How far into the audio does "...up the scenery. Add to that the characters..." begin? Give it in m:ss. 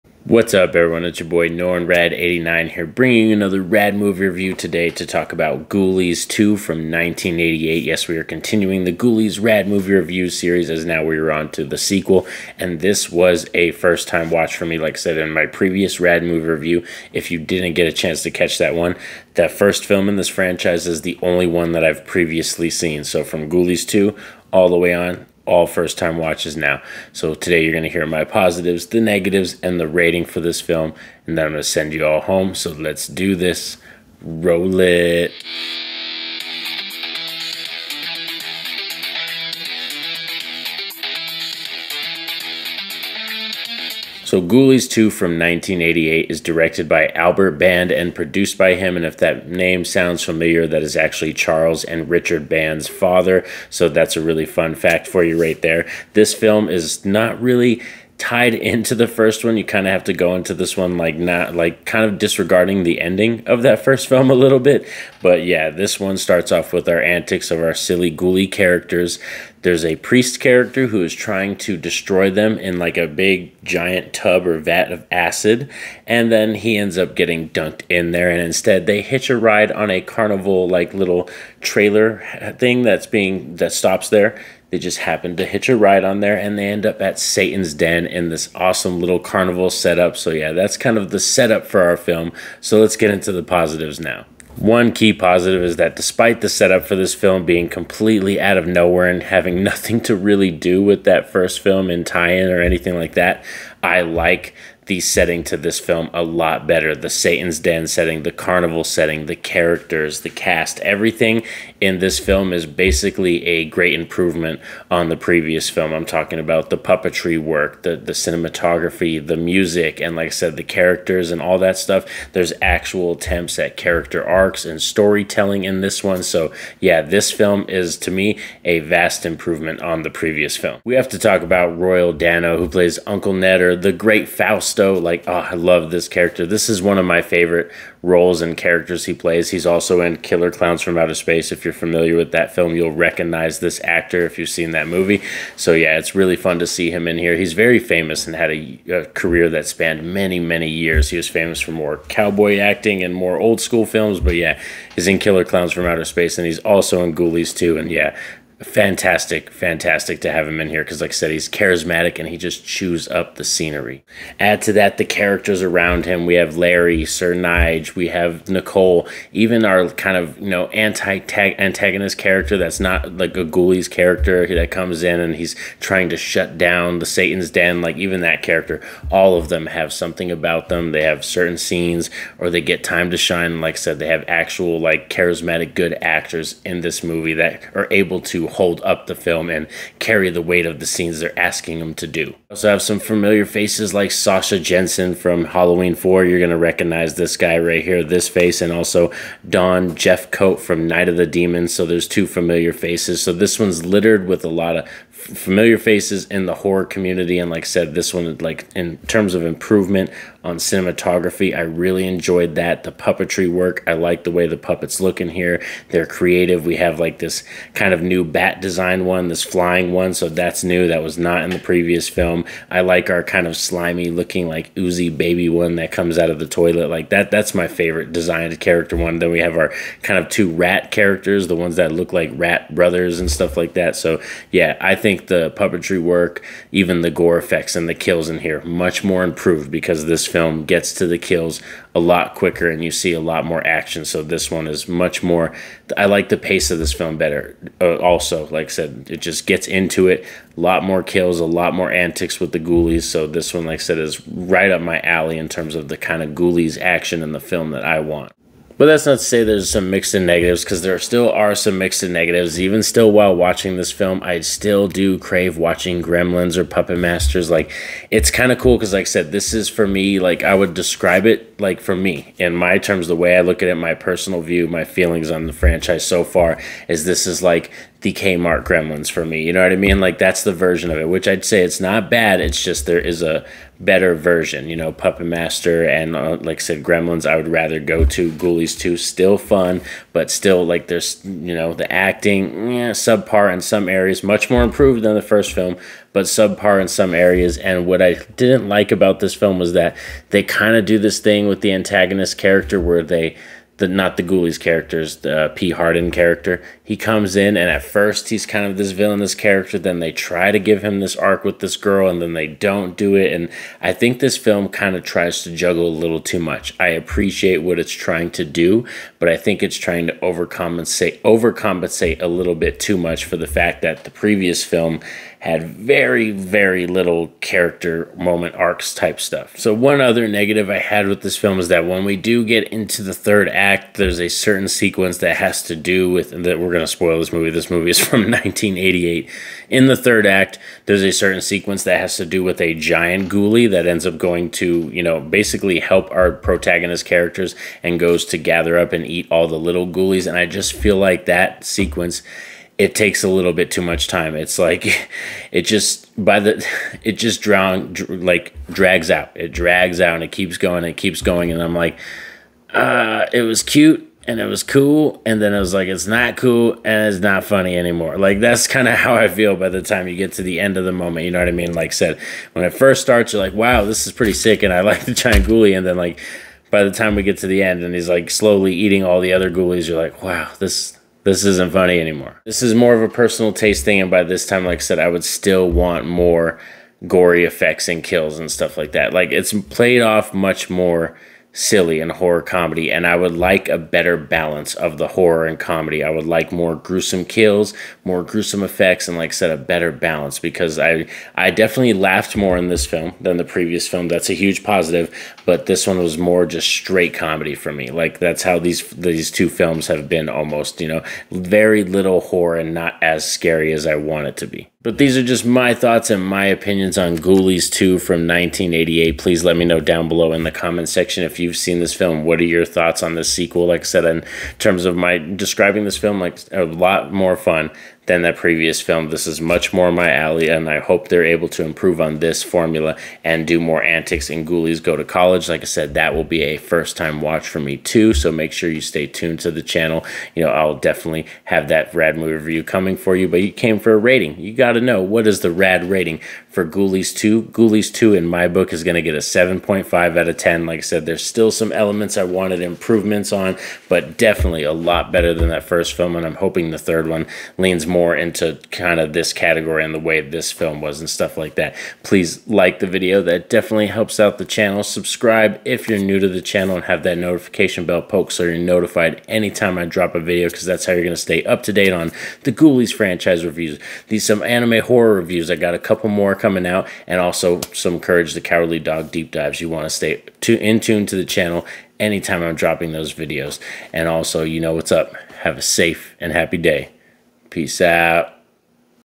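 2:43.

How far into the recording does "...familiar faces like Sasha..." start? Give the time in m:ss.
3:12.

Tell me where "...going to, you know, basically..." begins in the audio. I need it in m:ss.
5:44.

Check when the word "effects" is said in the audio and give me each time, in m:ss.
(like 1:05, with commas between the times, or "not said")
3:57, 6:27, 6:38.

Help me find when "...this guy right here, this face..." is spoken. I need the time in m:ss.
3:17.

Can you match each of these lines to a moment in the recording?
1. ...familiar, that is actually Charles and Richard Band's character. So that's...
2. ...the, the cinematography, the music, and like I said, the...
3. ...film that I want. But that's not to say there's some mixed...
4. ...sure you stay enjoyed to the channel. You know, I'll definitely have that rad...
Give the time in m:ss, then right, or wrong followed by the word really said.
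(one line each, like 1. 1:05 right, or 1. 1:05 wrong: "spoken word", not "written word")
1. 0:50 wrong: "father", not "character"
2. 1:57 right
3. 4:17 right
4. 7:18 wrong: "tuned", not "enjoyed".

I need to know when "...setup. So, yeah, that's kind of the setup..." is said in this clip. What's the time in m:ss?
1:29.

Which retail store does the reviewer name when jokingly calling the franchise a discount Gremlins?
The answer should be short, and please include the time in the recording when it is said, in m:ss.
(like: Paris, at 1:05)
Kmart, at 4:38.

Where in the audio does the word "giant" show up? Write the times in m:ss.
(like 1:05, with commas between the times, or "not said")
1:13, 5:42, 6:15.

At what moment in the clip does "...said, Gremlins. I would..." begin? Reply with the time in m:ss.
4:46.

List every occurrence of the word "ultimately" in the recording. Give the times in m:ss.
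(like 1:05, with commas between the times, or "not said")
not said.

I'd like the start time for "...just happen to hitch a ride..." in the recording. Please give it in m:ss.
1:24.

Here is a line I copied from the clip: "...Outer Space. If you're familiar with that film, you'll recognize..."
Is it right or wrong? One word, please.
right.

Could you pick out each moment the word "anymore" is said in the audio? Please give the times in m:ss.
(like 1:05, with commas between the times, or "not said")
6:07, 6:21.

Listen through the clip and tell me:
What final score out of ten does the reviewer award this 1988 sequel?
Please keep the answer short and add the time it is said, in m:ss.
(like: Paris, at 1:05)
7.5, at 7:29.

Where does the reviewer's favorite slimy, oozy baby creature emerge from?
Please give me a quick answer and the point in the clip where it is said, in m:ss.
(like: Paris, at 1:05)
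the toilet, at 3:46.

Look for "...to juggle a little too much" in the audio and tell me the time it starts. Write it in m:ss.
5:15.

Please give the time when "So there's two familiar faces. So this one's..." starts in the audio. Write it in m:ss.
3:21.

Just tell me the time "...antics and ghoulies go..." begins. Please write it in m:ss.
7:13.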